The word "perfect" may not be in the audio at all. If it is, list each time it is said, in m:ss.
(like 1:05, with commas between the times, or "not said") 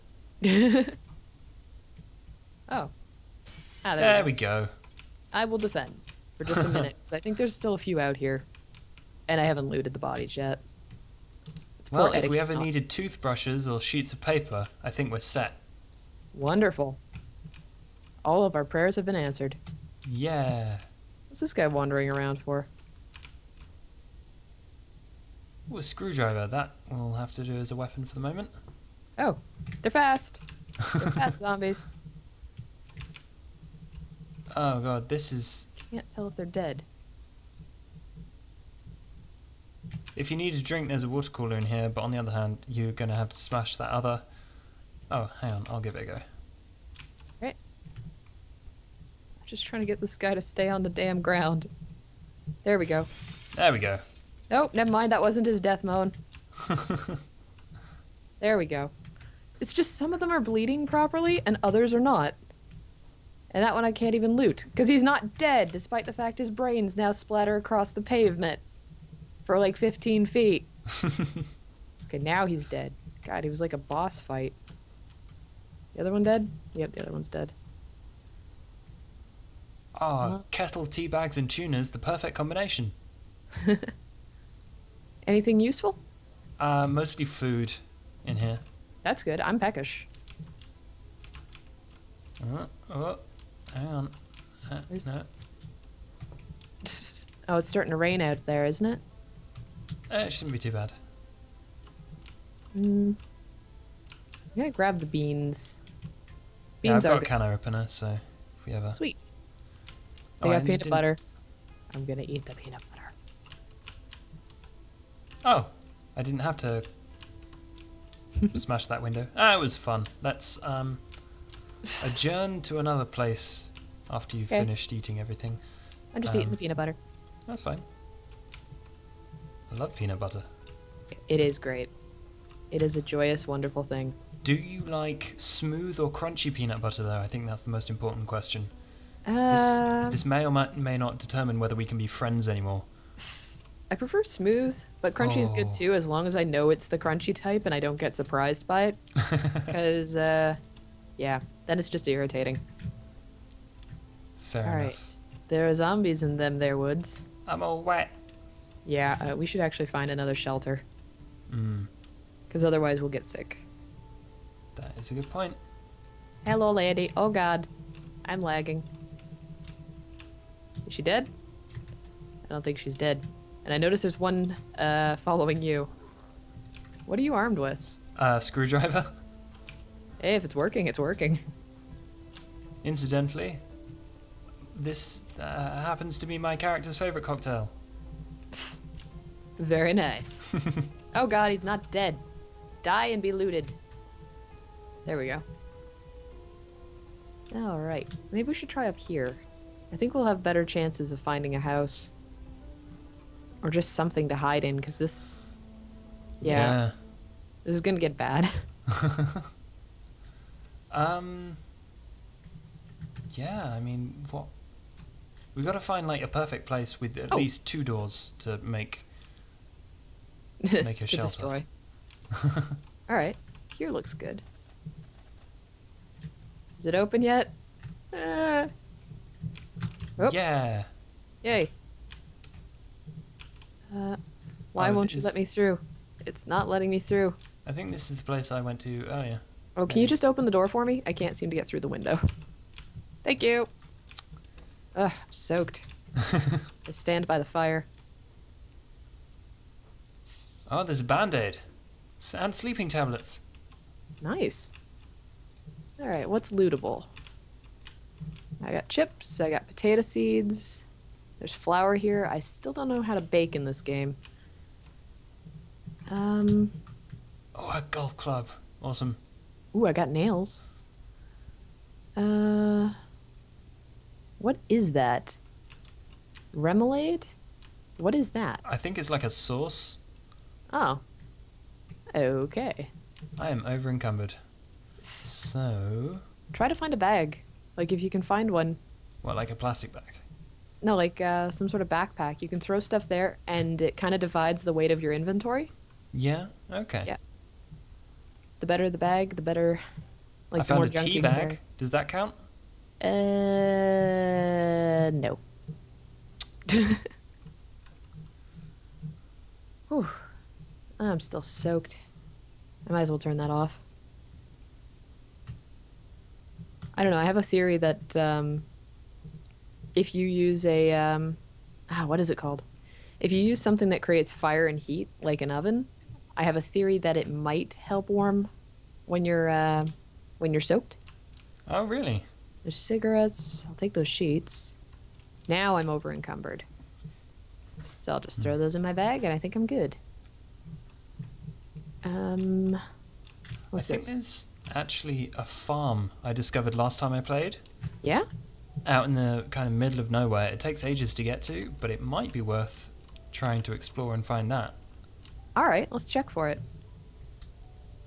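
1:21, 3:36.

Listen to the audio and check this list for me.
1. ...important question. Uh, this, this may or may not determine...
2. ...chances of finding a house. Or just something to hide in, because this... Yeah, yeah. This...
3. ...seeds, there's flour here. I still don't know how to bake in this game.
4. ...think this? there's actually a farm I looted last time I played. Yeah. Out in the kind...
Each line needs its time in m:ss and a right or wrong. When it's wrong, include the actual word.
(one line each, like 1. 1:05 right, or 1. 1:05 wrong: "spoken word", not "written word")
1. 2:17 right
2. 3:20 right
3. 4:20 right
4. 5:43 wrong: "discovered", not "looted".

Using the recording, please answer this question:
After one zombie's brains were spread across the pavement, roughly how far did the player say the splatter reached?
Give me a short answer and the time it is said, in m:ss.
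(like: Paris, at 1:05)
15 feet, at 1:09.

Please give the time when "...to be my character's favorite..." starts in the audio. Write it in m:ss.
3:06.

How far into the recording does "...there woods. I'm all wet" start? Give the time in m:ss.
2:36.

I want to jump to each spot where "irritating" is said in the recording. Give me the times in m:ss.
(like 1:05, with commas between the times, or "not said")
2:32.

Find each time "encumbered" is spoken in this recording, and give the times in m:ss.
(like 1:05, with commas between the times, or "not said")
4:43, 5:36.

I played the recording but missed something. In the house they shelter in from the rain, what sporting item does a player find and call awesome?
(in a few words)
Golf club.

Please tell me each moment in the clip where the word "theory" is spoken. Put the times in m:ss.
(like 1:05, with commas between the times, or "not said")
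5:17, 5:26.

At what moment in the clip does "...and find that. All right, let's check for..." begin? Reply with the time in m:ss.
5:54.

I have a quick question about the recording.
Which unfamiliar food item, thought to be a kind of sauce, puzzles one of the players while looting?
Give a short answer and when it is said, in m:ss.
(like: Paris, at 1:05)
Remoulade, at 4:36.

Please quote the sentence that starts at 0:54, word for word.
Nope, never mind, that wasn't his death moan.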